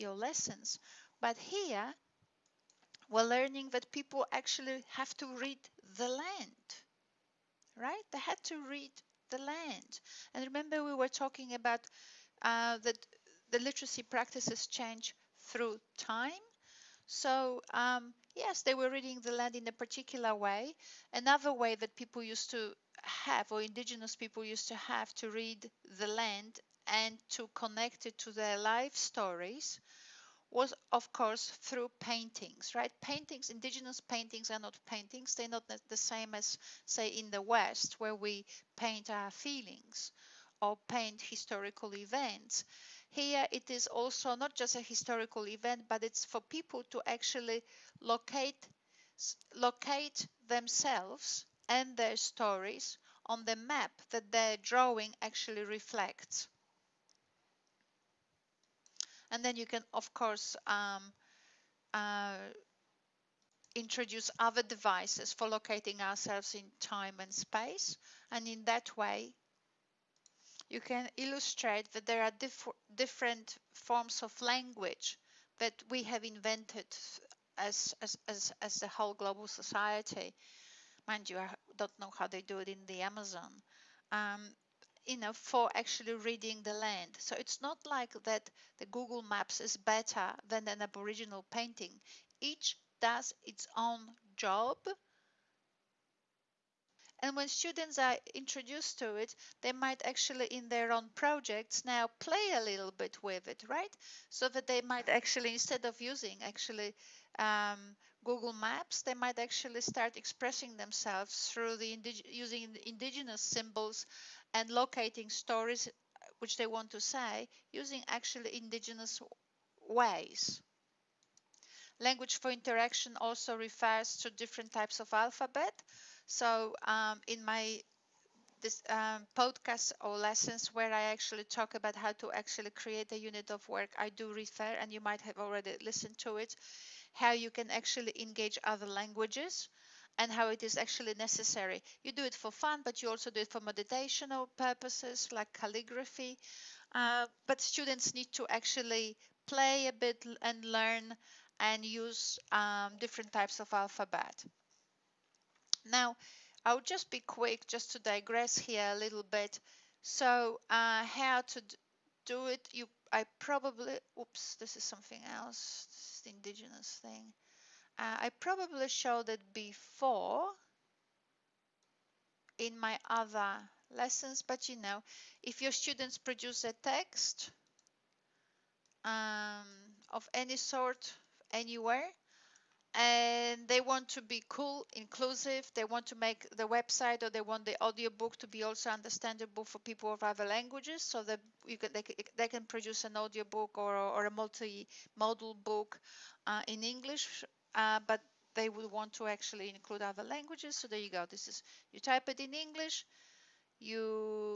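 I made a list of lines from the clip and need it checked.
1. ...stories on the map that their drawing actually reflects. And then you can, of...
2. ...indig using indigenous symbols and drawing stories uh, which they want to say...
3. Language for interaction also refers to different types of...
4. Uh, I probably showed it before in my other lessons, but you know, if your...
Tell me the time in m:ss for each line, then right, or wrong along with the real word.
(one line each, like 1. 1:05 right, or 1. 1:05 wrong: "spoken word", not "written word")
1. 0:52 right
2. 1:51 wrong: "locating", not "drawing"
3. 2:01 right
4. 2:47 right.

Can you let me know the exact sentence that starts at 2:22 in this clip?
You do it for fun, but you also do it for meditational purposes like calligraphy.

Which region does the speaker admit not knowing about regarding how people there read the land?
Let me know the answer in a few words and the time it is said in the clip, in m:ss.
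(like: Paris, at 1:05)
the Amazon, at 1:22.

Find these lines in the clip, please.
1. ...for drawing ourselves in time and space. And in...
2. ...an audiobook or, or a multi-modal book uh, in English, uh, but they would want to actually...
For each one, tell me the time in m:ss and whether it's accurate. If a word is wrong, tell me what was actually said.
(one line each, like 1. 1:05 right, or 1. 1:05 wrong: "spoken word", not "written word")
1. 1:05 wrong: "locating", not "drawing"
2. 3:13 right.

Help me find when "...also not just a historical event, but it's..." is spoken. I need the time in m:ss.
0:43.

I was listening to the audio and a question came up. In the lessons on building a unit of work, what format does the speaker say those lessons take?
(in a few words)
podcast.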